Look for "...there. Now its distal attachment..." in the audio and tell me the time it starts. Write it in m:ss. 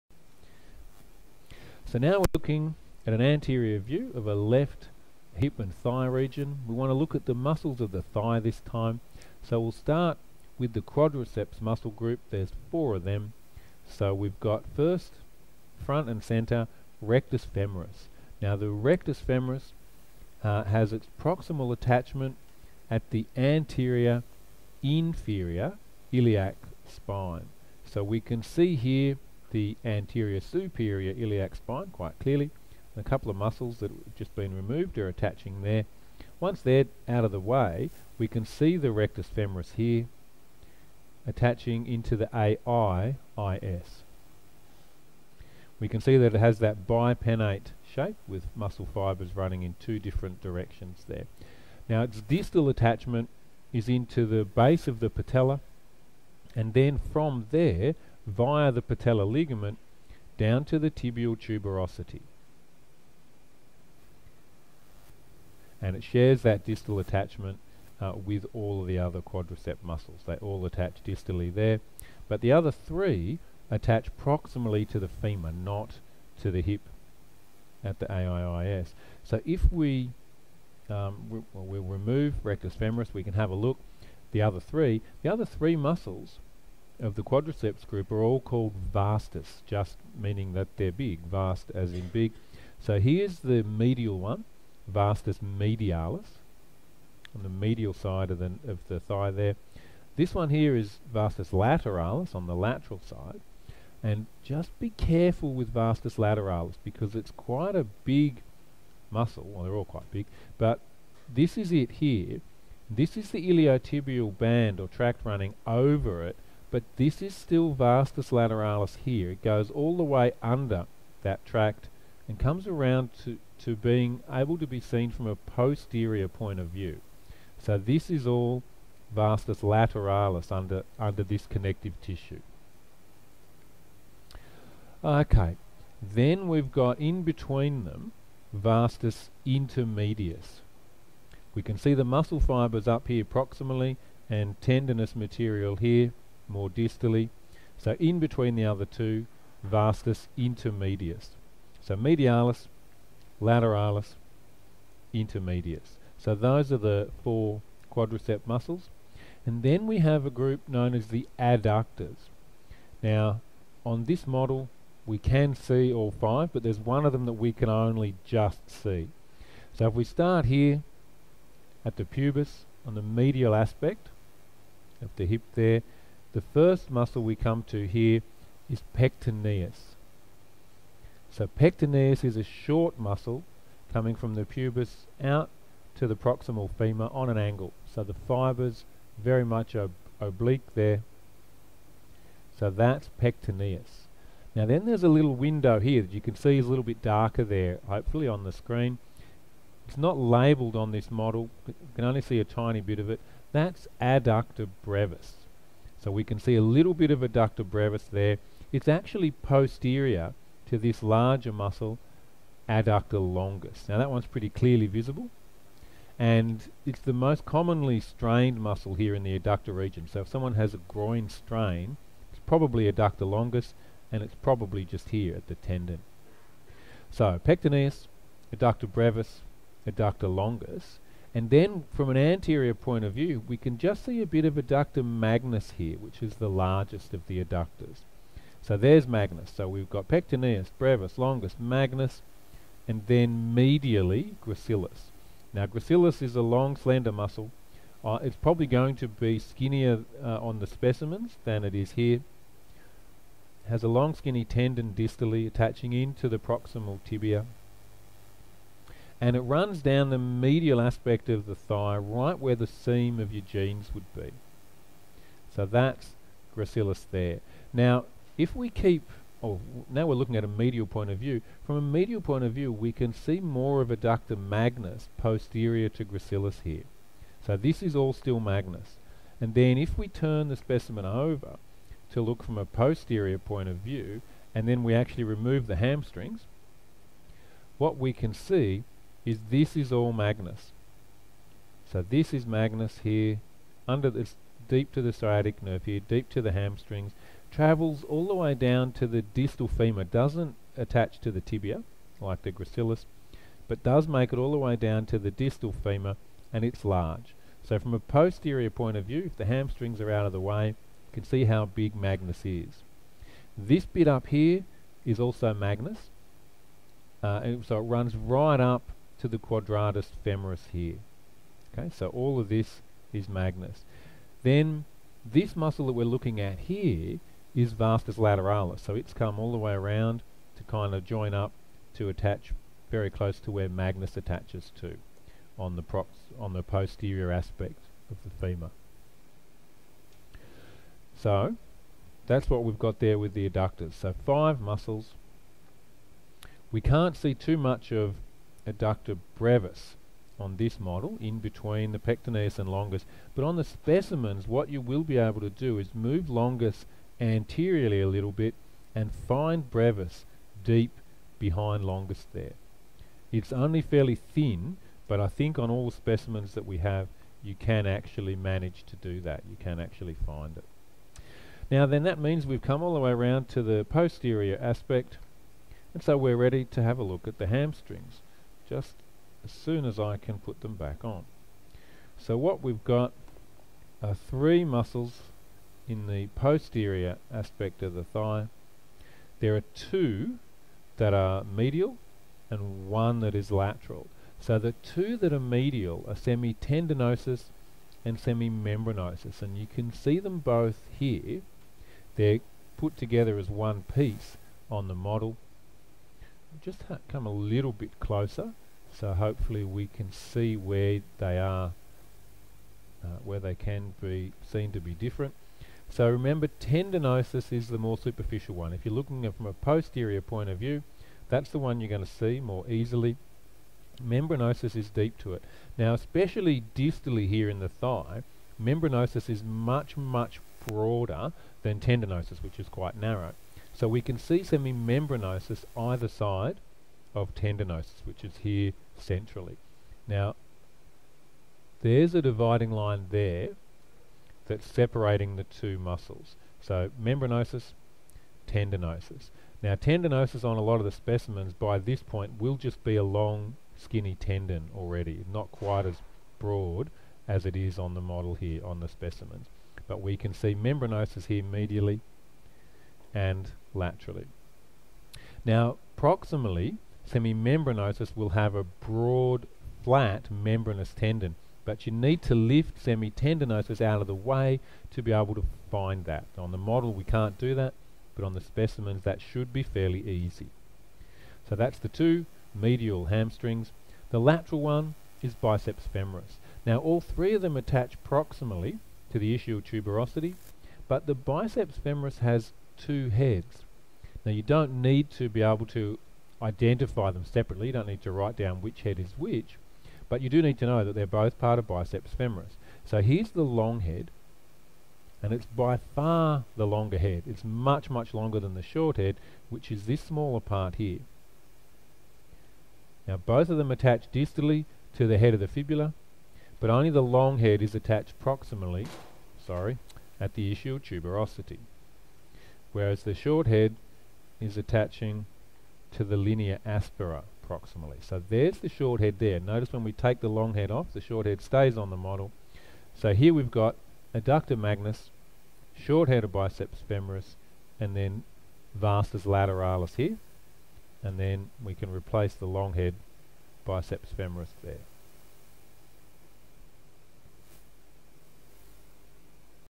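0:51.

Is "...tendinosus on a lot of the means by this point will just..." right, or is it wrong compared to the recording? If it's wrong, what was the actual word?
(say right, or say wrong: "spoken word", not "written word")
wrong: "specimens", not "means".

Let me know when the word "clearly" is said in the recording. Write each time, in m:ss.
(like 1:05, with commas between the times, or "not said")
0:32, 3:34.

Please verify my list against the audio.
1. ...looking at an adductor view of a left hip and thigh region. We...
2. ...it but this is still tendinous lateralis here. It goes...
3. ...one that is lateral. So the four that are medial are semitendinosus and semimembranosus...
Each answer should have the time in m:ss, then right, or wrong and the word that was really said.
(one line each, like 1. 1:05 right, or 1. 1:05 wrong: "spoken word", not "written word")
1. 0:02 wrong: "anterior", not "adductor"
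2. 1:56 wrong: "vastus", not "tendinous"
3. 6:32 wrong: "two", not "four".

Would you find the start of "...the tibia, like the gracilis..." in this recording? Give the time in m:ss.
5:01.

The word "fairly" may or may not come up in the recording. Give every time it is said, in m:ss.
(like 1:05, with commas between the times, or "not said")
6:03, 7:59.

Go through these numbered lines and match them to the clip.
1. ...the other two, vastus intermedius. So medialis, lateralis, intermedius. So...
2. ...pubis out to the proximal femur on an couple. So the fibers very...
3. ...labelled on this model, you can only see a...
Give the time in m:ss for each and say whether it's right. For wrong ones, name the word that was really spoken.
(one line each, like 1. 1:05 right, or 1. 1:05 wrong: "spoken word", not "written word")
1. 2:28 right
2. 3:04 wrong: "angle", not "couple"
3. 3:20 right.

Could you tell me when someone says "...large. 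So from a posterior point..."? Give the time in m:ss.
5:06.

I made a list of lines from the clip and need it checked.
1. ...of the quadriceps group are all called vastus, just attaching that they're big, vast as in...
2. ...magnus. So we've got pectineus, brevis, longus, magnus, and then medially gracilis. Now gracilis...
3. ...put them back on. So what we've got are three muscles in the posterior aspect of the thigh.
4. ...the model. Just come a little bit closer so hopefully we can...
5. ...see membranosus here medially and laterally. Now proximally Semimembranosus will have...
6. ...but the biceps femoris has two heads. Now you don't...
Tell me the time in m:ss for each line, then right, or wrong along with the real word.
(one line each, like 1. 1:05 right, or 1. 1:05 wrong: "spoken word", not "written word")
1. 1:27 wrong: "meaning", not "attaching"
2. 3:59 right
3. 6:20 right
4. 6:44 right
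5. 7:40 right
6. 8:10 right.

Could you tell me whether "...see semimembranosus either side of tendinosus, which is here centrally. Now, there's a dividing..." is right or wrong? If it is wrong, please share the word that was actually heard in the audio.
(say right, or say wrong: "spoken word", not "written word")
right.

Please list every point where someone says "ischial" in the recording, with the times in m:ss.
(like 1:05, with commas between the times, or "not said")
8:09, 8:40.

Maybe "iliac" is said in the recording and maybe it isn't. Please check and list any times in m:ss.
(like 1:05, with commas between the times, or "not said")
0:26, 0:31.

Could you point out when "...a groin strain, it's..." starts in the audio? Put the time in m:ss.
3:40.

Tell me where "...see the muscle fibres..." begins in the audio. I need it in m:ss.
2:21.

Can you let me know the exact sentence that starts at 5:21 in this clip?
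Okay, so all of this is magnus.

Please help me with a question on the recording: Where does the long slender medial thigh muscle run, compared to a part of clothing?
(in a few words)
Seam of your jeans.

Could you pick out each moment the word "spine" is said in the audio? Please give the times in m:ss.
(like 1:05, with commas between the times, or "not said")
0:26, 0:31.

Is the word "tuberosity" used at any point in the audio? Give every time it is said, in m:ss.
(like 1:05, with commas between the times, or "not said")
1:01, 8:09, 8:40.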